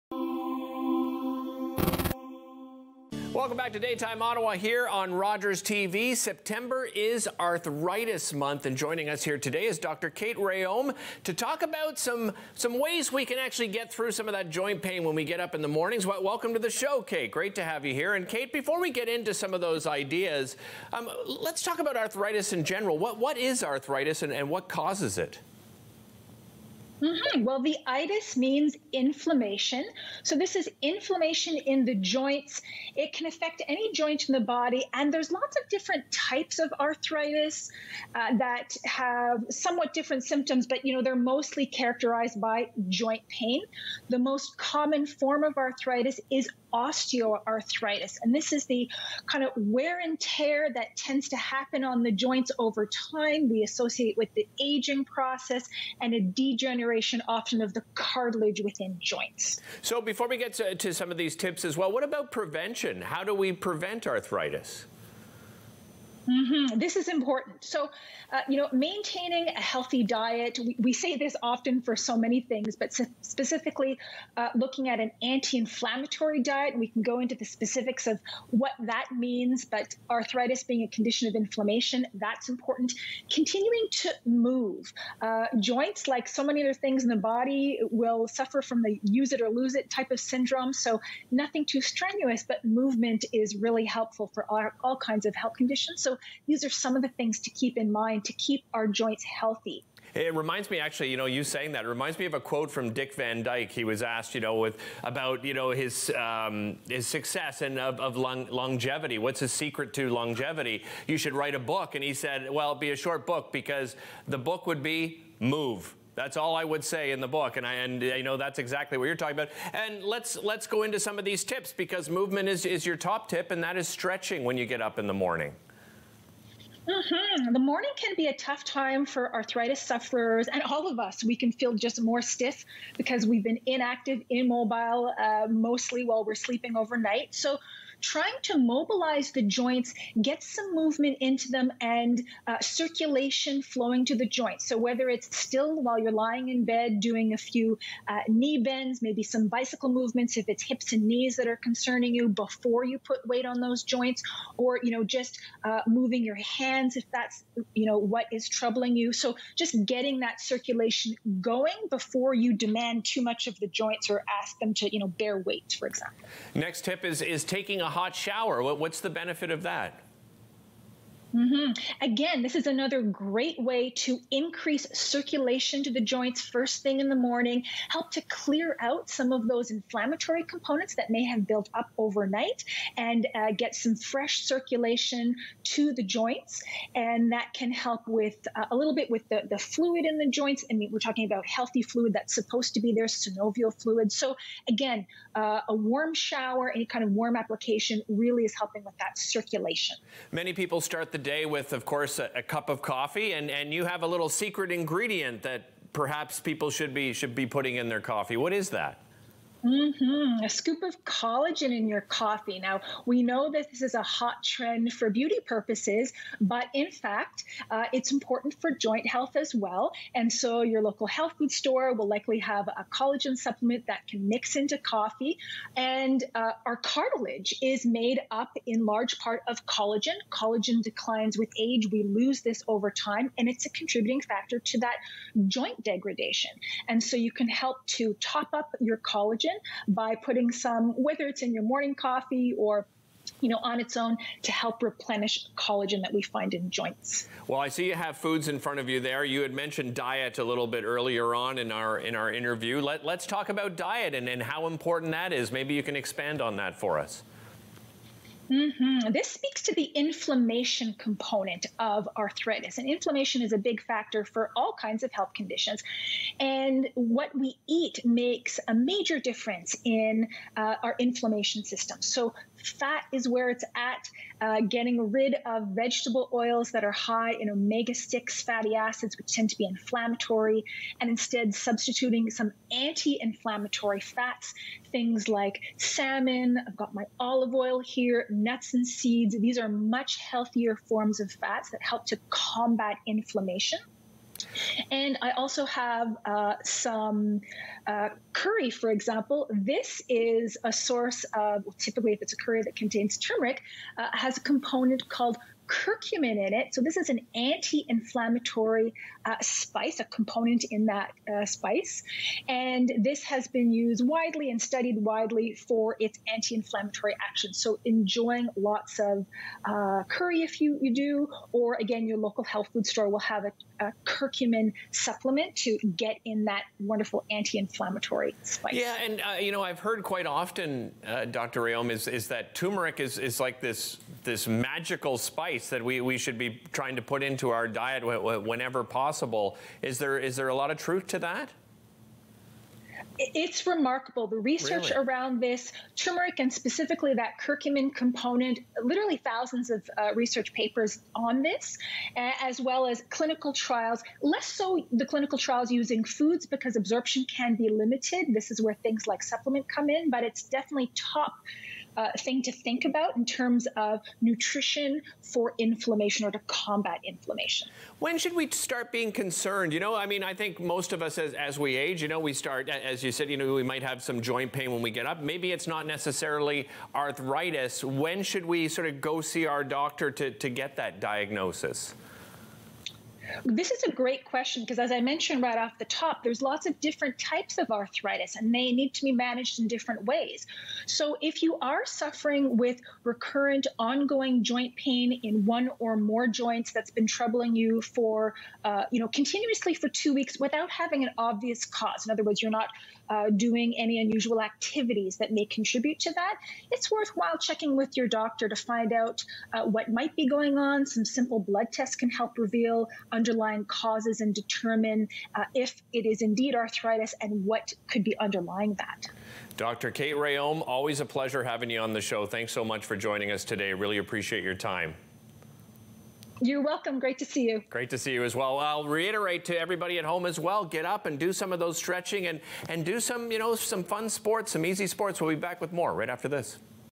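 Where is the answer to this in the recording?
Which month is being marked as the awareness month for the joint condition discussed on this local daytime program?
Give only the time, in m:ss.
0:06.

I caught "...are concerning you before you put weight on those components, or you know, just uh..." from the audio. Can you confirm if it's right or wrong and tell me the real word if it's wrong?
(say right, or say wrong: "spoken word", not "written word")
wrong: "joints", not "components".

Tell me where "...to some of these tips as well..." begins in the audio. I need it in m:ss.
1:00.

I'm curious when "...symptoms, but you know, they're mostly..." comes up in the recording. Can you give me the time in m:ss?
0:40.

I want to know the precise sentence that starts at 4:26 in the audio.
And what we eat makes a major difference in uh, our inflammation system.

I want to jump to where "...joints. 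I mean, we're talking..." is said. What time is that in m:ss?
3:10.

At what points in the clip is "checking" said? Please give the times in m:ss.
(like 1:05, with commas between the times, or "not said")
6:47.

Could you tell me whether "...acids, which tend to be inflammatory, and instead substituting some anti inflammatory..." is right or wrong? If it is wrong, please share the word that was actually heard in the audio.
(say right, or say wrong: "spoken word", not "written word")
right.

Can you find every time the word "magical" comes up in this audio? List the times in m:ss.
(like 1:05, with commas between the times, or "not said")
5:34.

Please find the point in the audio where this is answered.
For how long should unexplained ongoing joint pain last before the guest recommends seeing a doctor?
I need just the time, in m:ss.
6:39.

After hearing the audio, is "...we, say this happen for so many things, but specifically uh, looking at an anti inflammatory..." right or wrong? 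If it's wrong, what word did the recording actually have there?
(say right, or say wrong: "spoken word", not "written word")
wrong: "often", not "happen".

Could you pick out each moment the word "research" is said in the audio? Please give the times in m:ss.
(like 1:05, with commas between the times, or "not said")
5:44, 5:50.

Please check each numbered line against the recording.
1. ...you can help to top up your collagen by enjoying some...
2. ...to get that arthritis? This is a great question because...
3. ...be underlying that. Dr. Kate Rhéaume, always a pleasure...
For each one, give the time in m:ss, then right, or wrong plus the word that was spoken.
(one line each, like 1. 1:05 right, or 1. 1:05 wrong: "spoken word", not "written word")
1. 3:57 wrong: "putting", not "enjoying"
2. 6:20 wrong: "diagnosis", not "arthritis"
3. 6:58 right.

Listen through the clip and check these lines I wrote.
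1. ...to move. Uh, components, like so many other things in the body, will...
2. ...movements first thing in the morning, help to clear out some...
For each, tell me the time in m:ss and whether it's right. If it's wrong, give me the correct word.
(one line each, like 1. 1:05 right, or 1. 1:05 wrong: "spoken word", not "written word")
1. 1:23 wrong: "joints", not "components"
2. 2:56 wrong: "joints", not "movements".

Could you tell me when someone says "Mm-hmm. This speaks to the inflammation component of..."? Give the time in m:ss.
4:18.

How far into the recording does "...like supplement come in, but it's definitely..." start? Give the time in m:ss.
5:59.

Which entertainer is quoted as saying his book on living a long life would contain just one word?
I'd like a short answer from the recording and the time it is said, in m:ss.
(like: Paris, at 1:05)
Dick Van Dyke, at 1:42.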